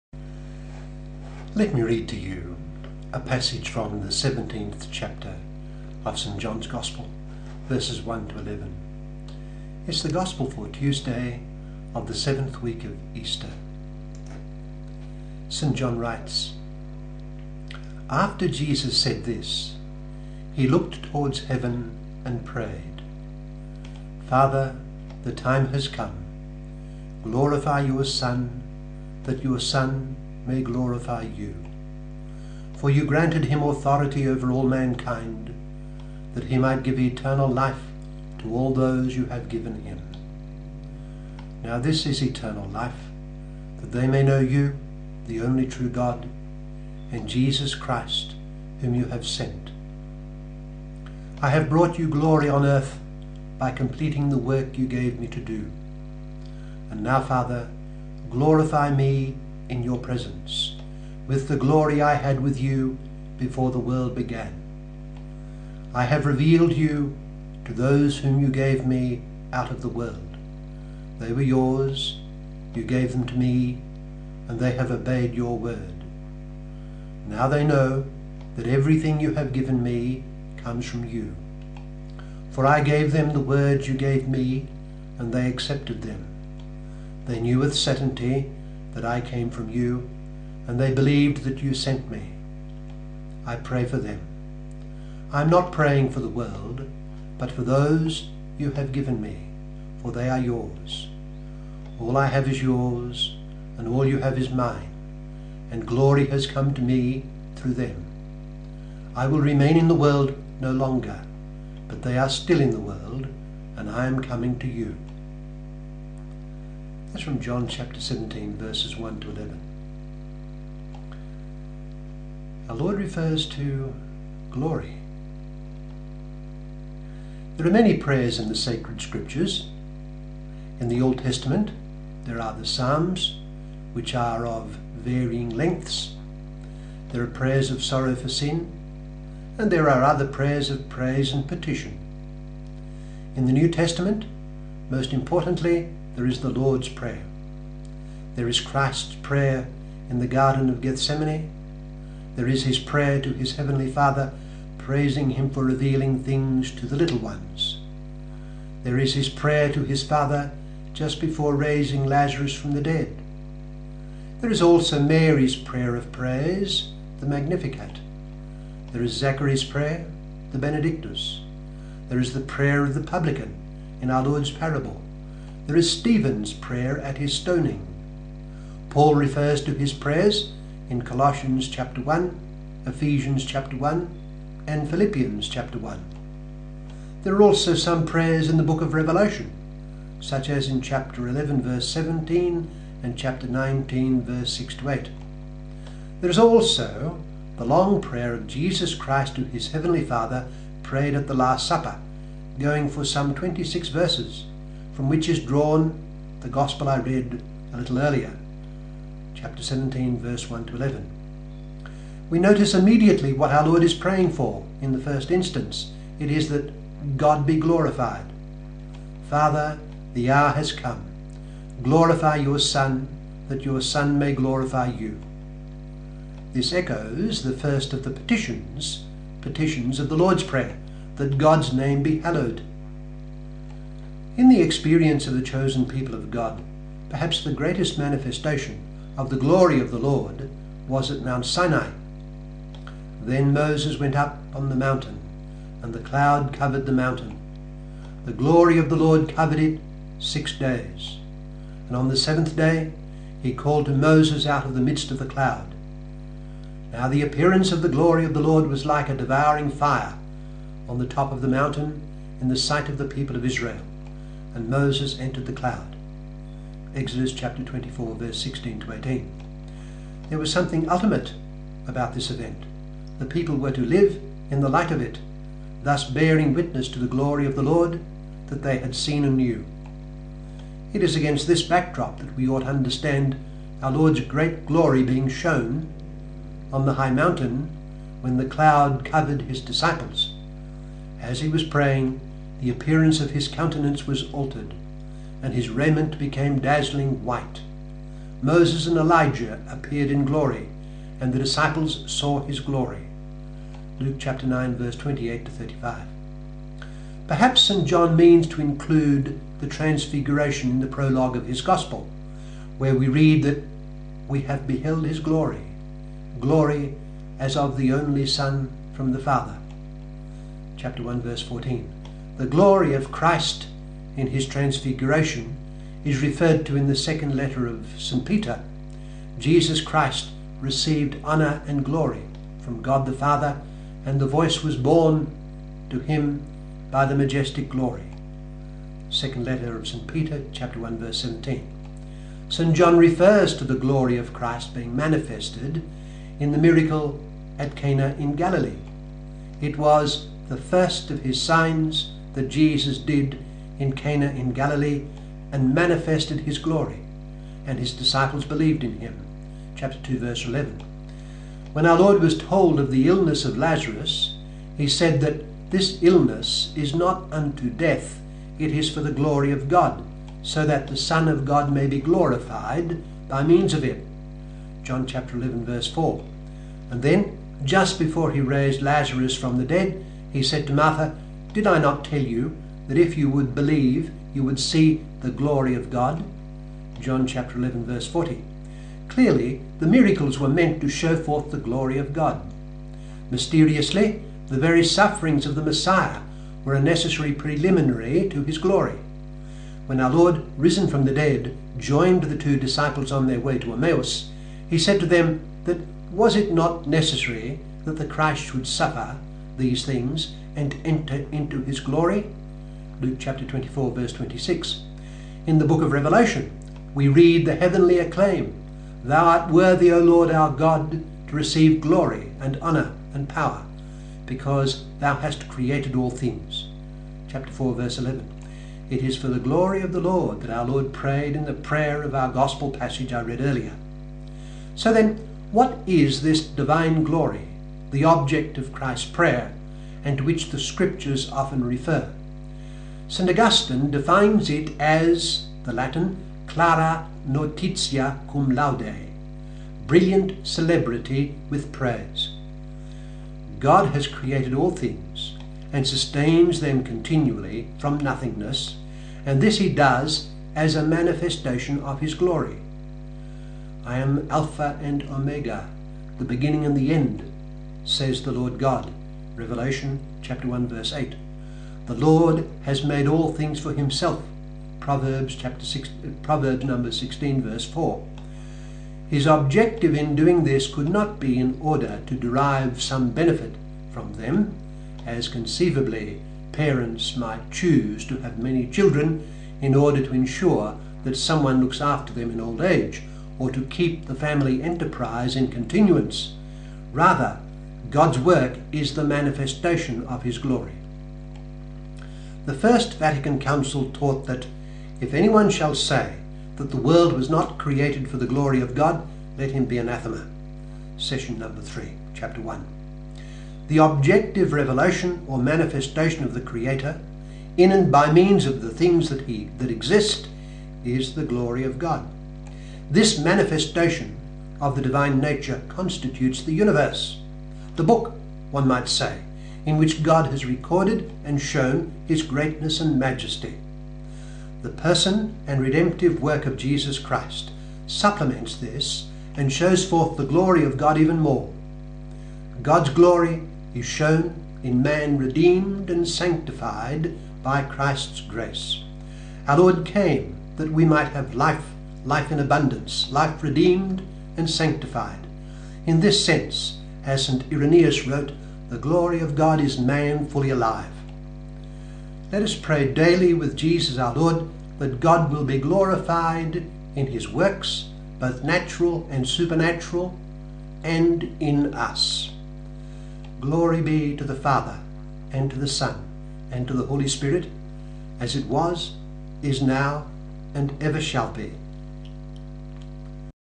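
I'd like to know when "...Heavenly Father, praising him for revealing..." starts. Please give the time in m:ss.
2:33.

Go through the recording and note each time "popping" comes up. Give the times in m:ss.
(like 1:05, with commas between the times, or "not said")
not said.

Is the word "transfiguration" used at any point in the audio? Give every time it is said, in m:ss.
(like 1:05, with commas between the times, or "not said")
5:09, 5:24.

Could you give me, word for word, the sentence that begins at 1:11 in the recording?
They were yours, you gave them to me, and they have obeyed your word.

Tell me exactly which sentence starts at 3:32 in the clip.
We notice immediately what our Lord is praying for in the first instance.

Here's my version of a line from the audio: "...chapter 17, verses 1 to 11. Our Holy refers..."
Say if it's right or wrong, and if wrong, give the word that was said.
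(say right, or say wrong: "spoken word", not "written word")
wrong: "Lord", not "Holy".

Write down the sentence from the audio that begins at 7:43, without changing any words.
I am Alpha and Omega, the beginning and the end, says the Lord God.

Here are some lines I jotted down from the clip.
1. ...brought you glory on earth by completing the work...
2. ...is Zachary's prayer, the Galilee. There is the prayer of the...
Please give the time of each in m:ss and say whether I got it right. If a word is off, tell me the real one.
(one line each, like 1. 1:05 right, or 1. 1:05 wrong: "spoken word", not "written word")
1. 0:51 right
2. 2:49 wrong: "Benedictus", not "Galilee".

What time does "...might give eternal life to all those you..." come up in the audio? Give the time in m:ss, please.
0:36.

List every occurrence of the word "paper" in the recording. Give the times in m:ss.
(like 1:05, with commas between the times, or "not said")
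not said.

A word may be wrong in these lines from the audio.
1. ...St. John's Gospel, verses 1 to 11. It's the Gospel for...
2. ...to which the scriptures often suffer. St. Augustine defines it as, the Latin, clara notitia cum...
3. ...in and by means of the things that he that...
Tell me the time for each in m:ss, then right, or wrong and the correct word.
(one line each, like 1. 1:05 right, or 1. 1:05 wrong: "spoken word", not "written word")
1. 0:06 right
2. 7:20 wrong: "refer", not "suffer"
3. 8:37 right.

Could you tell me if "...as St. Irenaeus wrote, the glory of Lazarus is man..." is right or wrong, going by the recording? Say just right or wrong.
wrong.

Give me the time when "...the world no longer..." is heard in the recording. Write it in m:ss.
1:49.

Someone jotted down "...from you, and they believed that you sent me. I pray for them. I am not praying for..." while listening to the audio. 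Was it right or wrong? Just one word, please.
right.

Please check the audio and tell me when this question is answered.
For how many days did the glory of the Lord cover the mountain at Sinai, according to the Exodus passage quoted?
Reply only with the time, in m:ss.
4:10.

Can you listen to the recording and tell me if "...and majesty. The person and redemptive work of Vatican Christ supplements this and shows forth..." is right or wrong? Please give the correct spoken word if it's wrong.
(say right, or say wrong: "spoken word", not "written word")
wrong: "Jesus", not "Vatican".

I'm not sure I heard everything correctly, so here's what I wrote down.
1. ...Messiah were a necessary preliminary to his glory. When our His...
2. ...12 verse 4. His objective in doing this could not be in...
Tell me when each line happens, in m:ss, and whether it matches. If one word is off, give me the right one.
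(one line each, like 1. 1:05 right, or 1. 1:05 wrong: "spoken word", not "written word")
1. 6:35 wrong: "Lord", not "His"
2. 7:56 wrong: "16", not "12".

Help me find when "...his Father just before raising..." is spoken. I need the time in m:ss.
2:39.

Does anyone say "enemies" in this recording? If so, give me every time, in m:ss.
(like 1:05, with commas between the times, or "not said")
not said.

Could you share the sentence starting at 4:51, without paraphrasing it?
As he was praying, the appearance of his countenance was altered, and his raiment became dazzling white.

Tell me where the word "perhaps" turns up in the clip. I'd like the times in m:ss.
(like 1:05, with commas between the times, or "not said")
3:57, 5:07.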